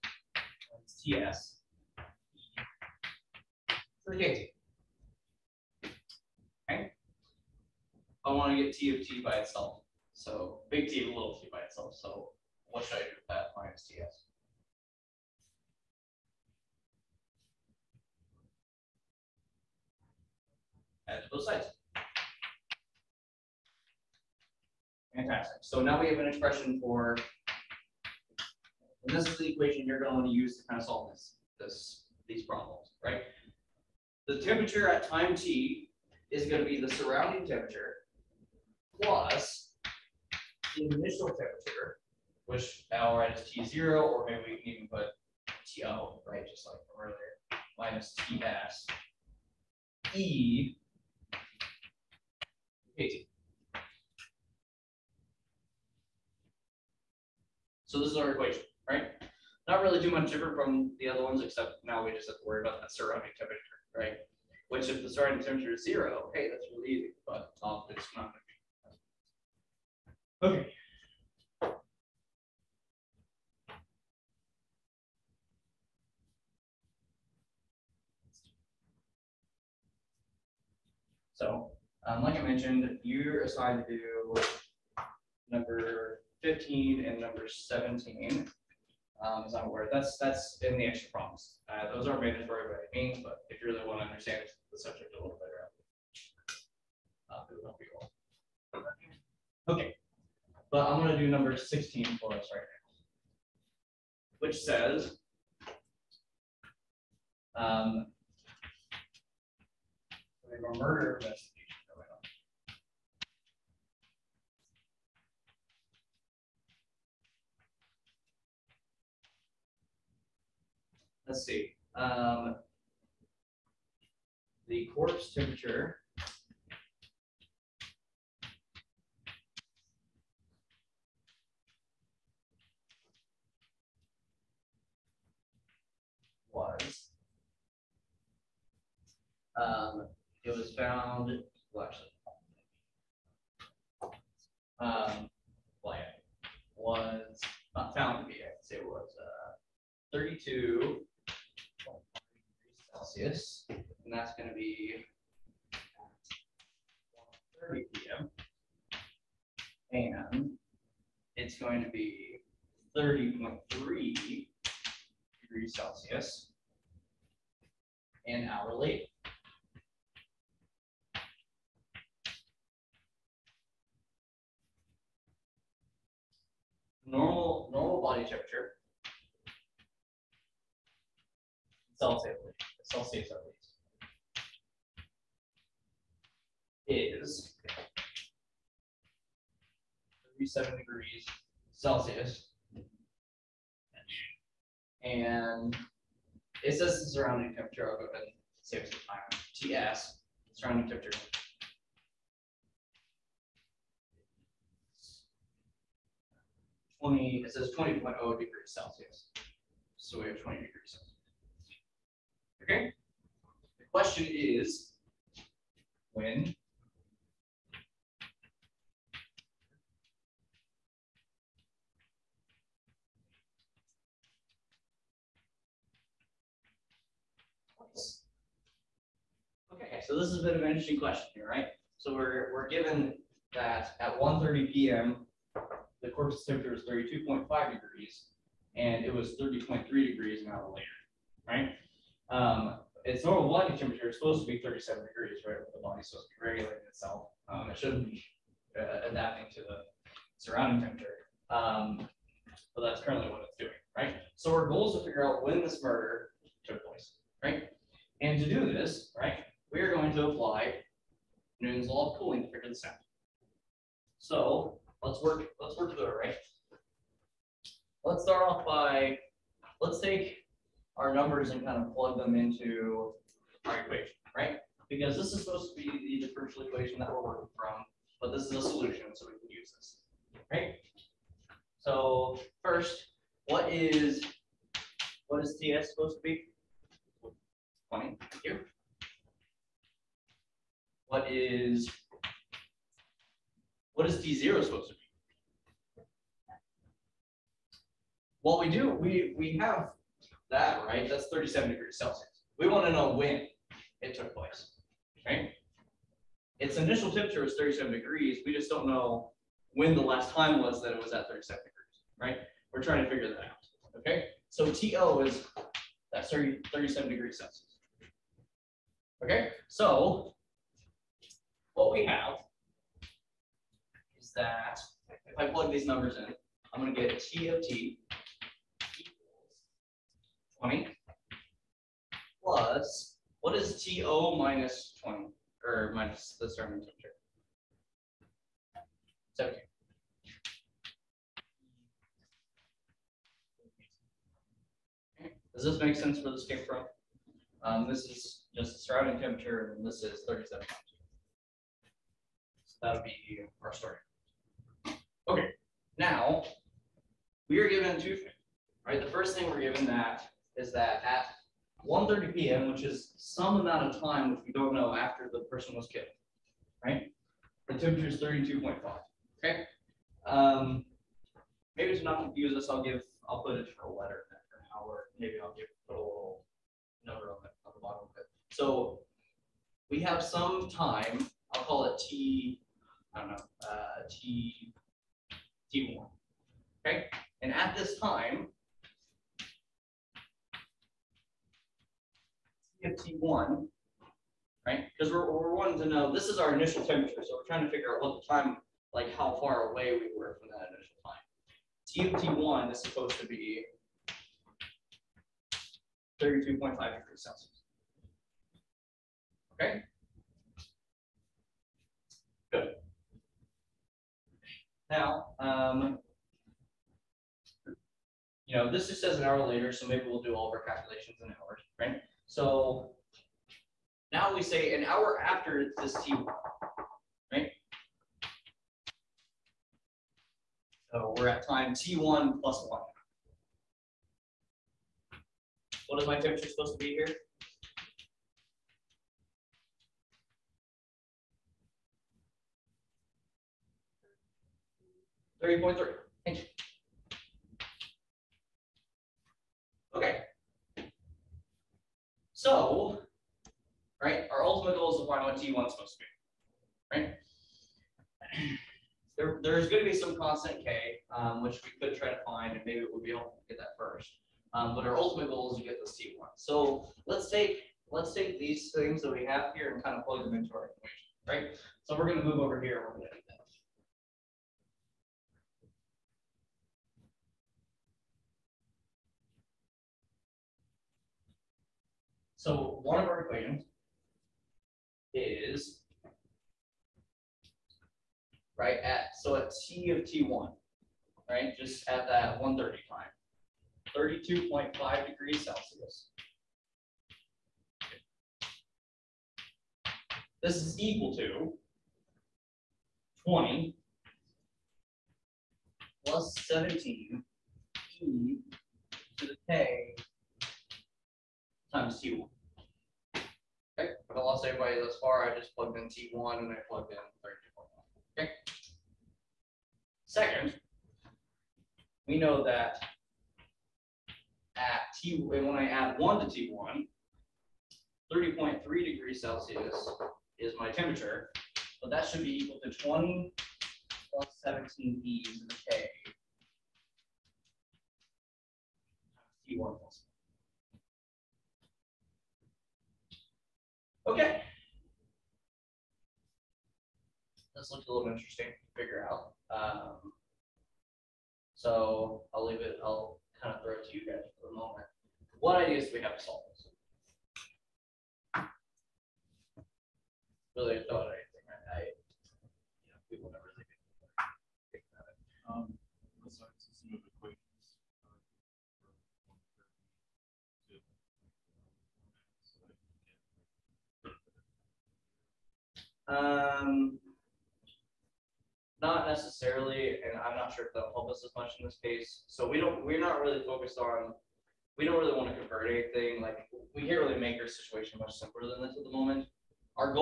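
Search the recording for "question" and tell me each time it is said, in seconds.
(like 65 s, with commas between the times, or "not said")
213 s, 230 s.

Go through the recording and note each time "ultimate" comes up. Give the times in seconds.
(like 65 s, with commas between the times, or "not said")
454 s, 464 s.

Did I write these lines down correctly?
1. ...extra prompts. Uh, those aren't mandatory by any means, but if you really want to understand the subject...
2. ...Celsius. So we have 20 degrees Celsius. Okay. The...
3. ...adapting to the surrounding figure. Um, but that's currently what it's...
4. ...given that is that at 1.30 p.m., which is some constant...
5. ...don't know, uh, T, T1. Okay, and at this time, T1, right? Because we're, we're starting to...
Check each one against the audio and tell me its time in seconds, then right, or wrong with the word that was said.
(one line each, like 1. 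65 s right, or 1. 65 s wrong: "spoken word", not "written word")
1. 90 s right
2. 208 s right
3. 249 s wrong: "temperature", not "figure"
4. 359 s wrong: "amount", not "constant"
5. 383 s wrong: "wanting", not "starting".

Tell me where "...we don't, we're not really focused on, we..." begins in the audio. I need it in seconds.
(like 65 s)
582 s.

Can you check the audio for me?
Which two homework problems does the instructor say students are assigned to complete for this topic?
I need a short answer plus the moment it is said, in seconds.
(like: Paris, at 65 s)
15 and 17, at 85 s.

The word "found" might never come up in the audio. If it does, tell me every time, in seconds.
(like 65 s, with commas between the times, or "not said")
140 s, 147 s.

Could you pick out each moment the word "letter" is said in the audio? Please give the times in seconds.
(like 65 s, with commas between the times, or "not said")
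373 s.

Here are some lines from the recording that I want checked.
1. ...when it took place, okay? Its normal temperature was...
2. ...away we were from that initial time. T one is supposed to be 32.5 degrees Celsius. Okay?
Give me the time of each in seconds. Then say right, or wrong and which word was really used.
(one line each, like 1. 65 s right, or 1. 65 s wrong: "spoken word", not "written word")
1. 303 s wrong: "initial", not "normal"
2. 399 s right.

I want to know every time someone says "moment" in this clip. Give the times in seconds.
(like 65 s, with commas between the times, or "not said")
554 s, 588 s.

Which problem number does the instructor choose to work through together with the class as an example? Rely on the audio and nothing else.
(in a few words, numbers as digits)
16.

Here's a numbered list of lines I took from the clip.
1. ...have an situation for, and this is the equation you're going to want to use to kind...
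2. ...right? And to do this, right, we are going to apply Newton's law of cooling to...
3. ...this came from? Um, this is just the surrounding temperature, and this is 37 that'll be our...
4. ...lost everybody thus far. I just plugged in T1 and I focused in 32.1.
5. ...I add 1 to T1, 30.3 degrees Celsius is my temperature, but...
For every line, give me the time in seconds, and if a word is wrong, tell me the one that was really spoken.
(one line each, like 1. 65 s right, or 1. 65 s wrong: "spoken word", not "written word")
1. 26 s wrong: "expression", not "situation"
2. 257 s right
3. 346 s right
4. 514 s wrong: "plugged", not "focused"
5. 525 s right.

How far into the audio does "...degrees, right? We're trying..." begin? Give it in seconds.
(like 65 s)
311 s.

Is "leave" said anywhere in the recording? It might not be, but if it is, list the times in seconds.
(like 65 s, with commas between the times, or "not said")
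552 s.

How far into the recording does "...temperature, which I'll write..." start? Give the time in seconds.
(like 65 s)
41 s.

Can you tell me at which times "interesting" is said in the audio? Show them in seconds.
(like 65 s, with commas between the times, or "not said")
230 s, 548 s.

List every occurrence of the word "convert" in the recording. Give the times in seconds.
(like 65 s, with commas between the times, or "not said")
585 s.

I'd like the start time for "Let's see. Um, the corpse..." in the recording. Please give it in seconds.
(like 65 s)
121 s.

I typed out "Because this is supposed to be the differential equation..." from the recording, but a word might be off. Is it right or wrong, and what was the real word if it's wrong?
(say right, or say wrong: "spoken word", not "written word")
right.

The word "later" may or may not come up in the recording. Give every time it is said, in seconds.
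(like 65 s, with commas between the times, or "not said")
240 s, 419 s.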